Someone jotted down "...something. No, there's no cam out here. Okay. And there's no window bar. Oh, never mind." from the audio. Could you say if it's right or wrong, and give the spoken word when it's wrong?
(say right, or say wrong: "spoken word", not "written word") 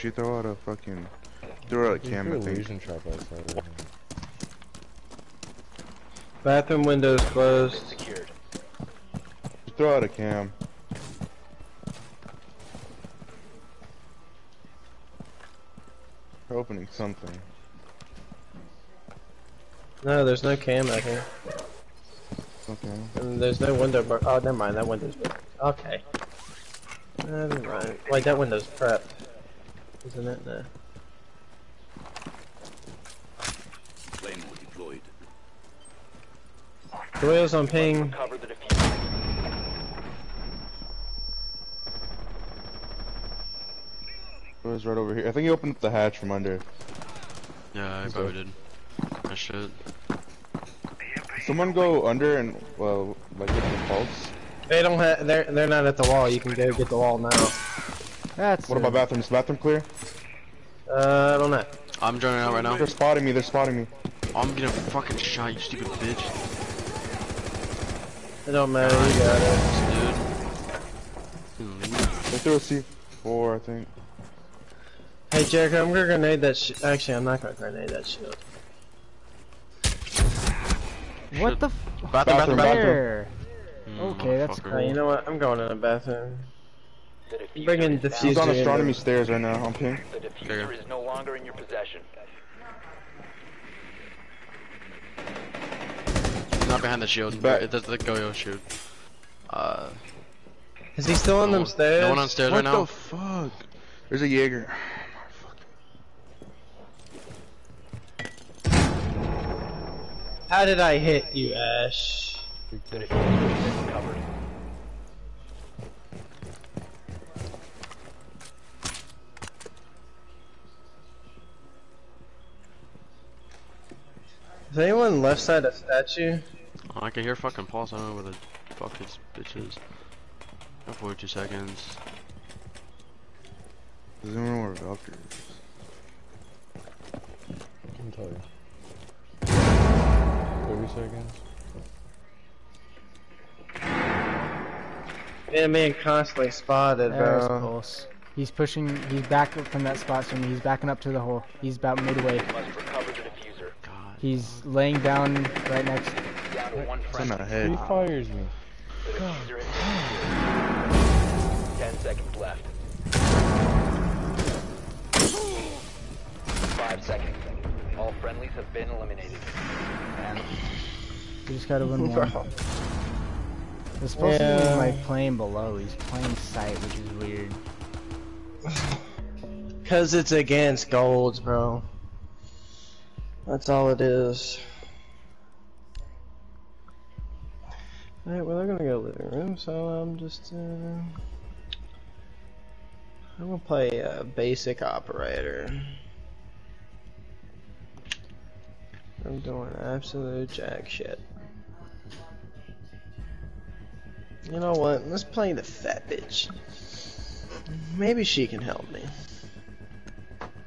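right.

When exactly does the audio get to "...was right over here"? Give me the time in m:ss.
0:44.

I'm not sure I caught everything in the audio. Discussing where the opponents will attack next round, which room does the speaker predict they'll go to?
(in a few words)
Living room.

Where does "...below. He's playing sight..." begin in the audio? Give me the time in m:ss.
2:55.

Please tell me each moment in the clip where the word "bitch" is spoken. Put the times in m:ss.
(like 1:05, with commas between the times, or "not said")
1:06, 2:09, 3:26.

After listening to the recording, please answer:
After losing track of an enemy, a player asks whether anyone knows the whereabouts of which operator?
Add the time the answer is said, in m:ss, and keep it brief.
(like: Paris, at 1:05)
Valkyrie, at 2:14.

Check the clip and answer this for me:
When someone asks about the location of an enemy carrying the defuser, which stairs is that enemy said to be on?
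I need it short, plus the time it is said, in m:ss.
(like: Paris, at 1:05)
Astronomy stairs, at 1:28.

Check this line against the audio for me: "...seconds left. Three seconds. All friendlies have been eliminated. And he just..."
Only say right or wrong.
wrong.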